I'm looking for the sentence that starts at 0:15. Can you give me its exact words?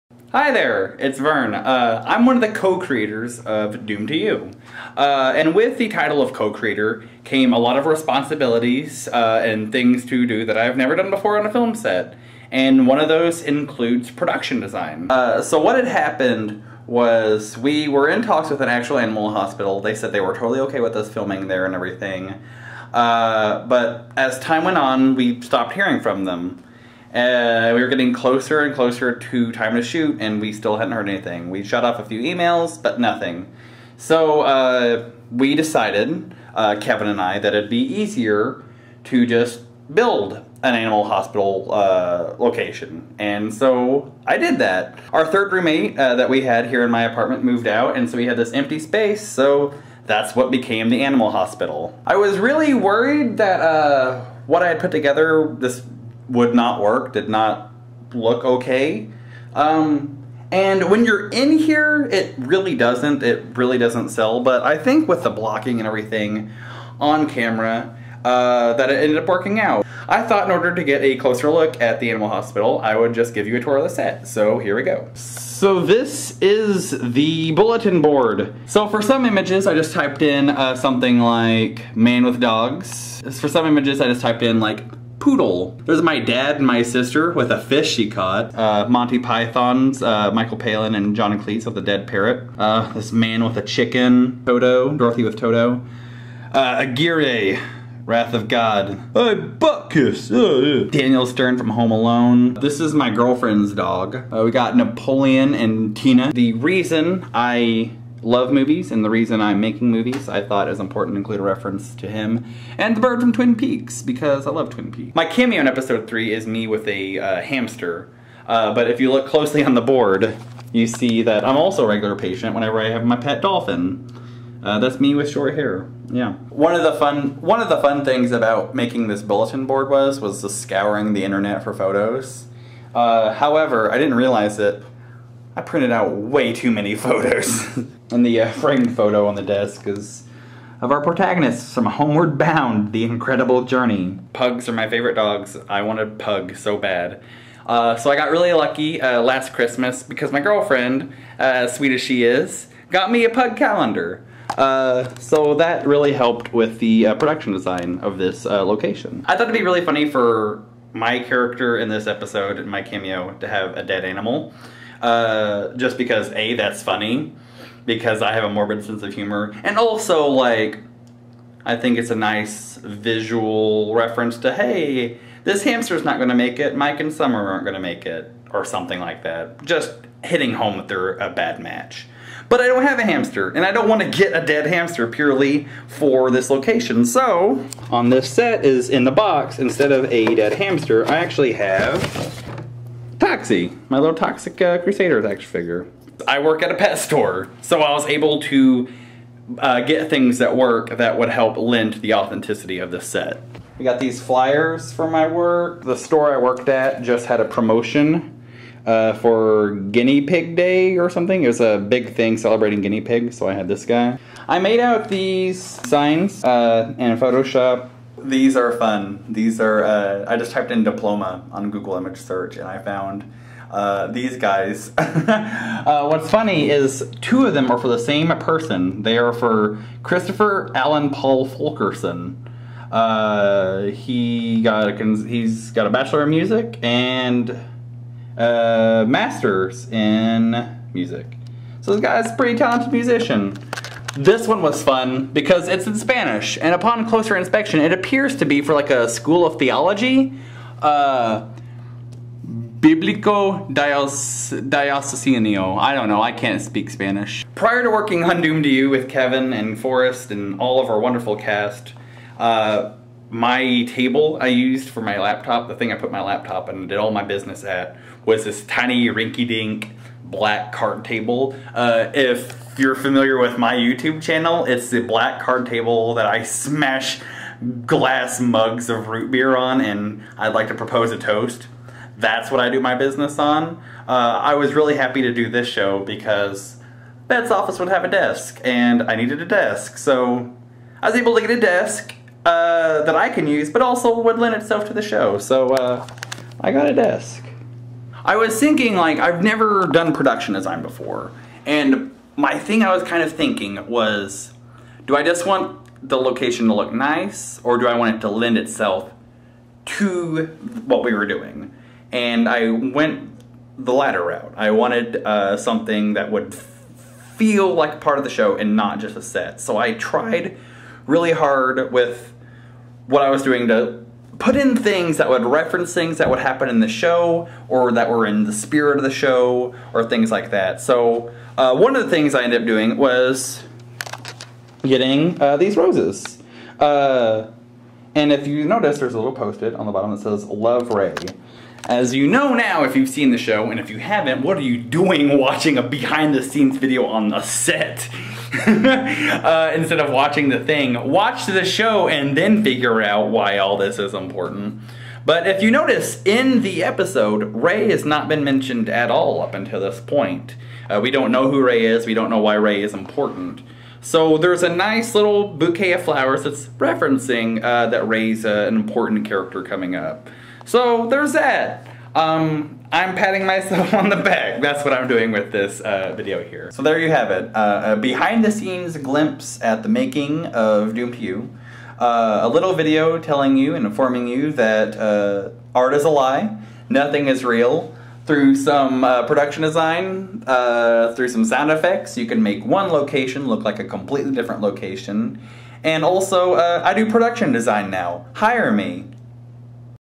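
Uh, so what had happened was we were in talks with an actual animal hospital.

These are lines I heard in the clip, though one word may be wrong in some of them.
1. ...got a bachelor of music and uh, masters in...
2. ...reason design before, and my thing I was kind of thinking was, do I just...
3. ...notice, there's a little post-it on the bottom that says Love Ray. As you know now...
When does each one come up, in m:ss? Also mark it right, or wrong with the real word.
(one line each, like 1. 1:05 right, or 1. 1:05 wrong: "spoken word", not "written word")
1. 3:55 right
2. 5:00 wrong: "production", not "reason"
3. 5:38 right.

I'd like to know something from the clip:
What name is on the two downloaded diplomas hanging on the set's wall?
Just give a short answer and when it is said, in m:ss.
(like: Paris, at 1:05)
Christopher Allen Paul Fulkerson, at 3:50.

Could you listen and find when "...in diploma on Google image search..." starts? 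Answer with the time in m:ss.
3:40.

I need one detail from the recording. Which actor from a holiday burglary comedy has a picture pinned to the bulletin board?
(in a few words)
Daniel Stern.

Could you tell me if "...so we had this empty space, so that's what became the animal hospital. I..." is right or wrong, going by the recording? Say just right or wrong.
right.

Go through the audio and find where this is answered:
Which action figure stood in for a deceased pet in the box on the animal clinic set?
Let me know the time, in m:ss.
3:13.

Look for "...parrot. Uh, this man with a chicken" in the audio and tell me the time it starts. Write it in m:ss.
1:32.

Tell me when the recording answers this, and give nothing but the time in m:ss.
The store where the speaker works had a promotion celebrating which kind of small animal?
3:29.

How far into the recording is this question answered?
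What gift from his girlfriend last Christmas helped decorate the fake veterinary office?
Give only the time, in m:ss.
2:33.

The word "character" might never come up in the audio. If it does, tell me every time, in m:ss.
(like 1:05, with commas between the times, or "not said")
2:41, 6:09.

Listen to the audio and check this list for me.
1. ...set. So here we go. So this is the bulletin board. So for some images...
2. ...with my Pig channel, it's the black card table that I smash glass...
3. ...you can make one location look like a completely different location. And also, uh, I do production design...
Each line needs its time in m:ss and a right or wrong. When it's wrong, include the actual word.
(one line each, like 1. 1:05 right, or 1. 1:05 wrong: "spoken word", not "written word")
1. 1:13 right
2. 4:33 wrong: "YouTube", not "Pig"
3. 6:32 right.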